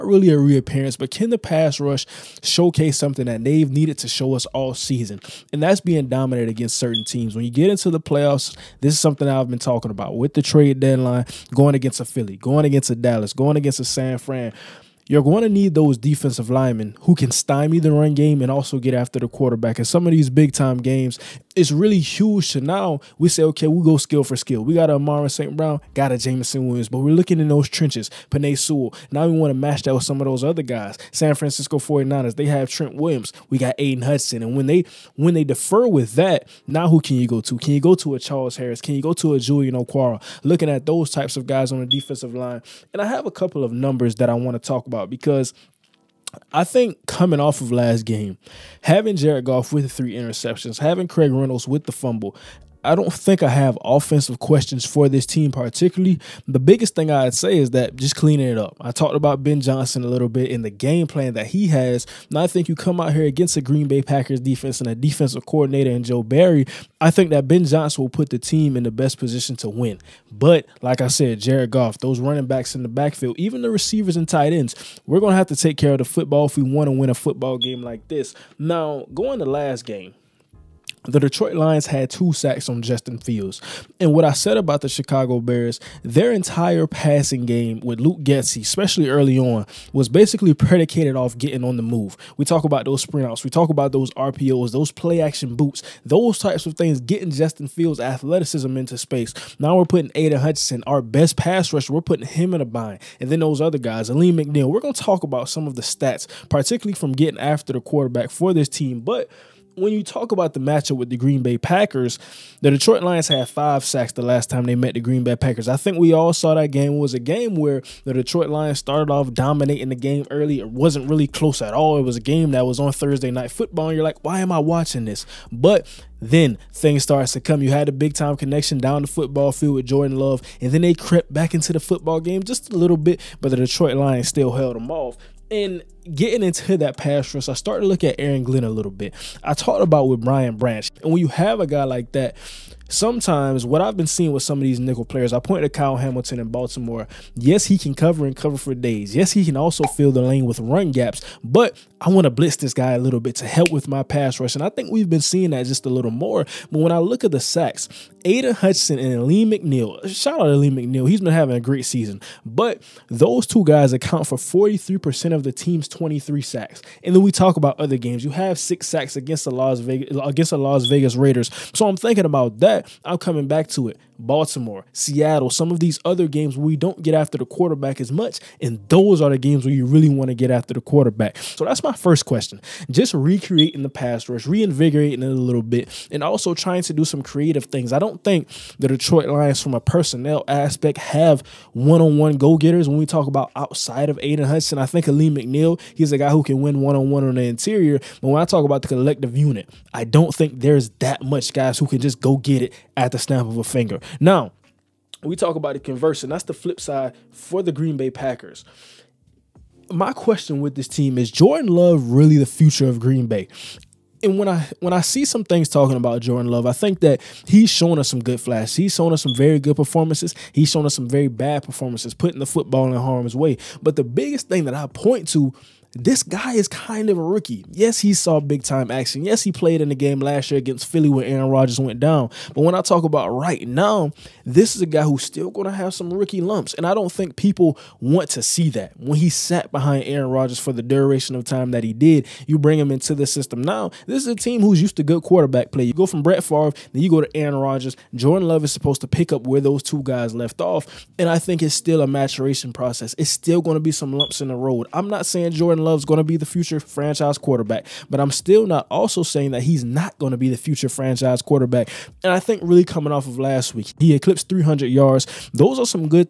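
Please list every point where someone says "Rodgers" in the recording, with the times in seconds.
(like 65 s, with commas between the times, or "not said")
231 s, 240 s, 247 s.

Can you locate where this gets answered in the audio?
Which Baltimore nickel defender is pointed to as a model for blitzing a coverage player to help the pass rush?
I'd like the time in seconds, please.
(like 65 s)
145 s.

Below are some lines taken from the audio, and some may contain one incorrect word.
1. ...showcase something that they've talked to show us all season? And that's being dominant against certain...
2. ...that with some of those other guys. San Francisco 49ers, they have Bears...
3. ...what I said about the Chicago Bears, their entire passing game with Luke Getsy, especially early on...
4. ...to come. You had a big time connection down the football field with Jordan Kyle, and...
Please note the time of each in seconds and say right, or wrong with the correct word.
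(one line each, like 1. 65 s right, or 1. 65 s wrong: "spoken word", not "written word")
1. 2 s wrong: "needed", not "talked"
2. 29 s wrong: "Trent", not "Bears"
3. 84 s right
4. 127 s wrong: "Love", not "Kyle".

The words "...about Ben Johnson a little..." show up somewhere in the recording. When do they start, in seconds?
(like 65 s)
59 s.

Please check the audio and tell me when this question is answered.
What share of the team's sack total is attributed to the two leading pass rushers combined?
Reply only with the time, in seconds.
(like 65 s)
164 s.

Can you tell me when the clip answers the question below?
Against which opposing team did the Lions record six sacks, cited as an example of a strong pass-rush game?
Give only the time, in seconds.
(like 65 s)
170 s.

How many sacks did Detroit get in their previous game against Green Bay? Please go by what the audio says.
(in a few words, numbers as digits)
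5.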